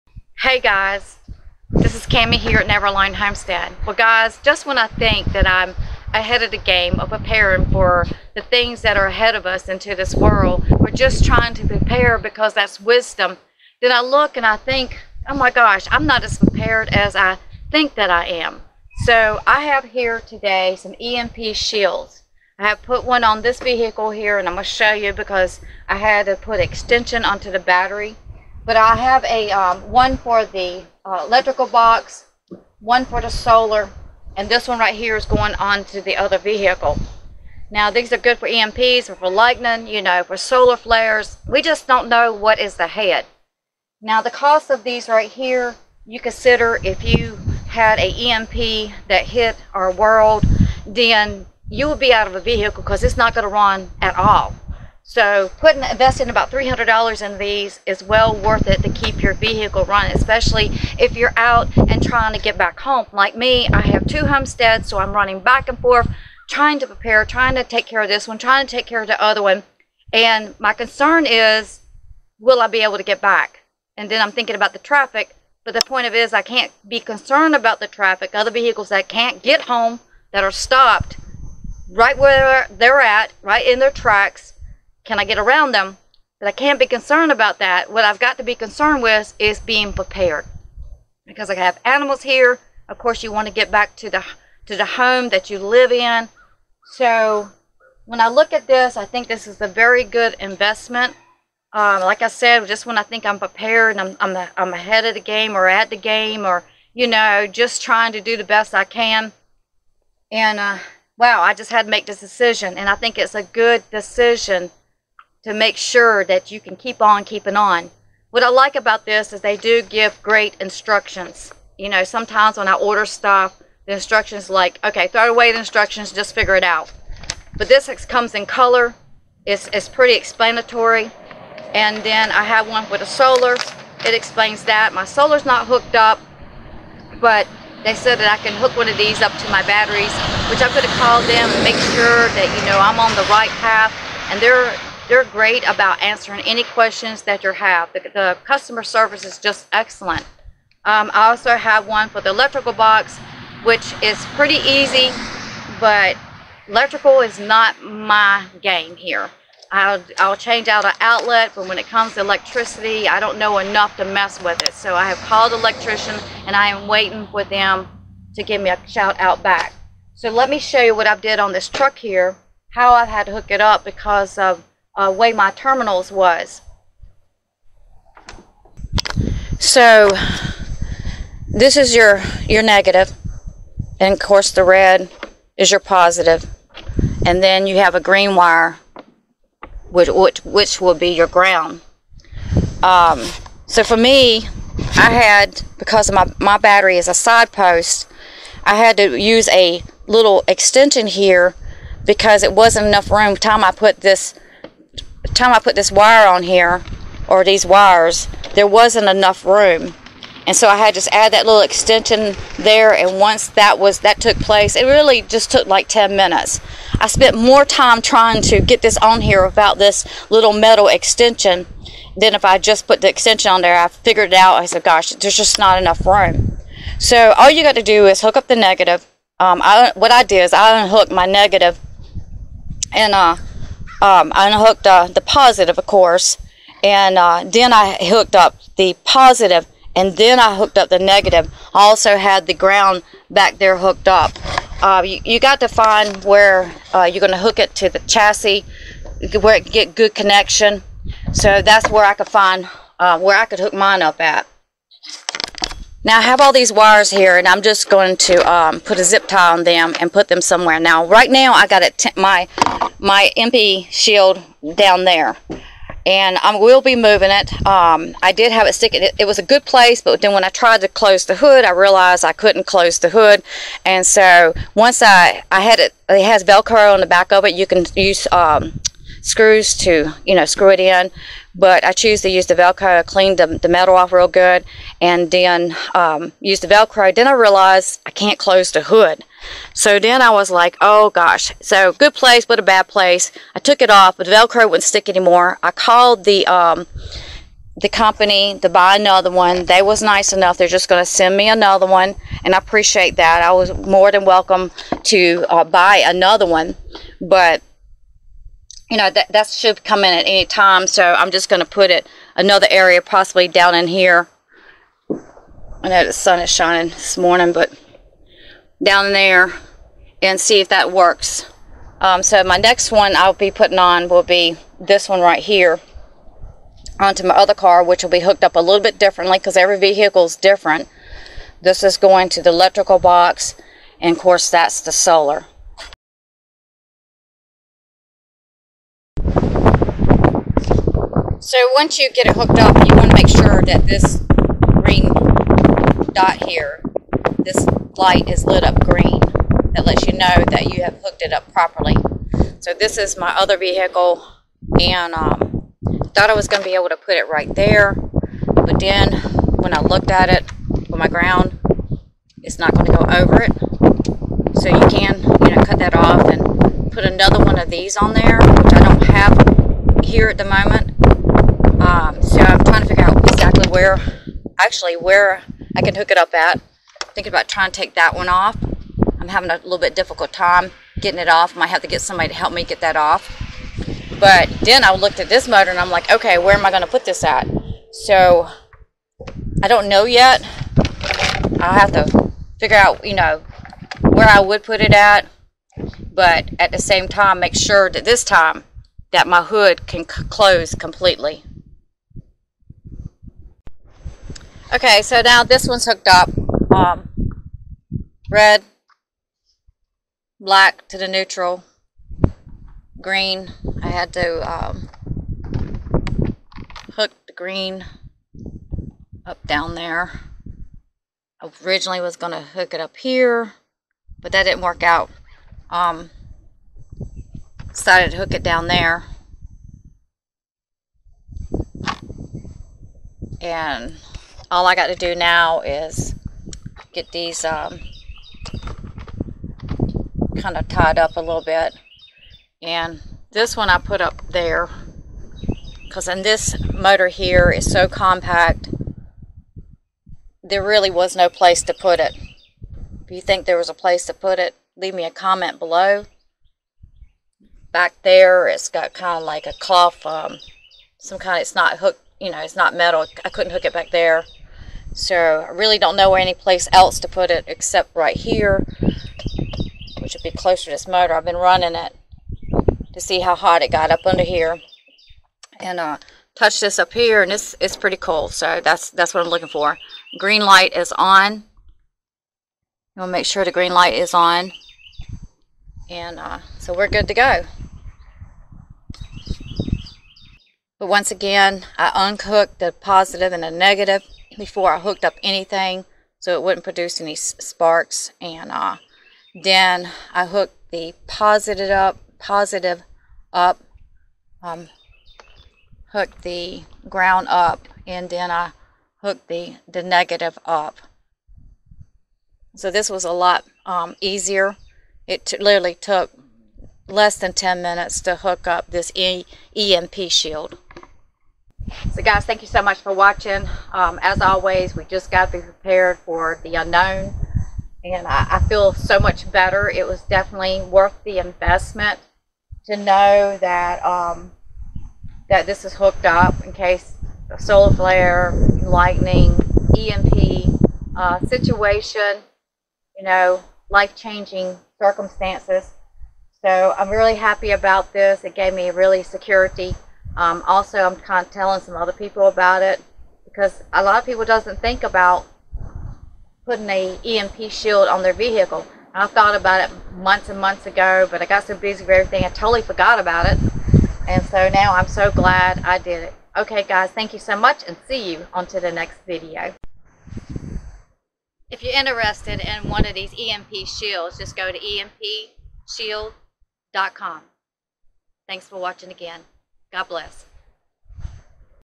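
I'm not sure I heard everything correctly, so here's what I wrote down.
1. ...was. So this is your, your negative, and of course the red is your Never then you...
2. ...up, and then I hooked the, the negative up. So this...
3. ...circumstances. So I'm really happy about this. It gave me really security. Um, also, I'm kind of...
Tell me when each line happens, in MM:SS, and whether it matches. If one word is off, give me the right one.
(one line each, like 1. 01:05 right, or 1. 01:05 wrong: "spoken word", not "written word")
1. 02:56 wrong: "And", not "Never"
2. 08:27 right
3. 09:04 right.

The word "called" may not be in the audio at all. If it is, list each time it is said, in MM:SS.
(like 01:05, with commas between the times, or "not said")
02:21, 02:45, 04:55.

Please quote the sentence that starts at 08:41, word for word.
So guys, thank you so much for watching.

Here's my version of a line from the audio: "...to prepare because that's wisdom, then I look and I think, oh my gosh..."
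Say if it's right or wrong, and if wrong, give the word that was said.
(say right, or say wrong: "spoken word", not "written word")
right.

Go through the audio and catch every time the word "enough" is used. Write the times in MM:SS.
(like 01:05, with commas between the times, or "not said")
02:43, 03:22, 03:29, 03:45, 05:00.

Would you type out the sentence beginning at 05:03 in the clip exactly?
I was more than welcome to uh, buy another one, but you know that that should come in at any time.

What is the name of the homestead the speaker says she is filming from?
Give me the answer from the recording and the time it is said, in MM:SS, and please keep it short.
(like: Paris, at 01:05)
Never Alone Homestead, at 00:02.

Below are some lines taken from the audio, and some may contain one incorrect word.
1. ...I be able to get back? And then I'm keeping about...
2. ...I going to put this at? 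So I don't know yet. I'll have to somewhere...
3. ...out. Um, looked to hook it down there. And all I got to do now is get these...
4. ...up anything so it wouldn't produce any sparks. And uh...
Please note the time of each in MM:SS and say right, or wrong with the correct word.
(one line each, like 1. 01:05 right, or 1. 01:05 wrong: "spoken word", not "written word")
1. 01:12 wrong: "thinking", not "keeping"
2. 06:26 wrong: "figure", not "somewhere"
3. 07:04 wrong: "decided", not "looked"
4. 08:15 right.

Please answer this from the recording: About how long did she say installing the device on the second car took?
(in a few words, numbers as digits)
less than 10 minutes.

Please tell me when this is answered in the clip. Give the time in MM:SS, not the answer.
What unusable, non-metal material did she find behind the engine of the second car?
07:39.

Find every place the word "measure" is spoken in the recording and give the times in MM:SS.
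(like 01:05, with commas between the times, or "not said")
not said.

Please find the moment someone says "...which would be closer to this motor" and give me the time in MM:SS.
07:50.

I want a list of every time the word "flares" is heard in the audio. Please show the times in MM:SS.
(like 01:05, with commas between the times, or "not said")
00:40, 08:57.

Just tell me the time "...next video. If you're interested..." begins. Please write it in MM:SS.
09:28.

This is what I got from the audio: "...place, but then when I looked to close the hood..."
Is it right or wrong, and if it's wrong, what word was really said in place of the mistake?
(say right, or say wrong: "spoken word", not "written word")
wrong: "tried", not "looked".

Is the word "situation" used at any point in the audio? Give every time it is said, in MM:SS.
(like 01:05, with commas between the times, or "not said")
09:01.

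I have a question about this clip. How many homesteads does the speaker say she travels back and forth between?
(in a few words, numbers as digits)
2.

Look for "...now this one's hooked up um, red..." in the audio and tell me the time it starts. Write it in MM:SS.
06:45.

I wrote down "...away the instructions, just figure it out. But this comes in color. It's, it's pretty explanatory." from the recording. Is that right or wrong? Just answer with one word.
right.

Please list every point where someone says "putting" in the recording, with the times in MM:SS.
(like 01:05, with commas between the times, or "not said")
00:55, 05:23, 09:16.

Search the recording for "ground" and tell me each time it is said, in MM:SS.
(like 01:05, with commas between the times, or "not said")
03:11, 04:02, 06:01, 08:26.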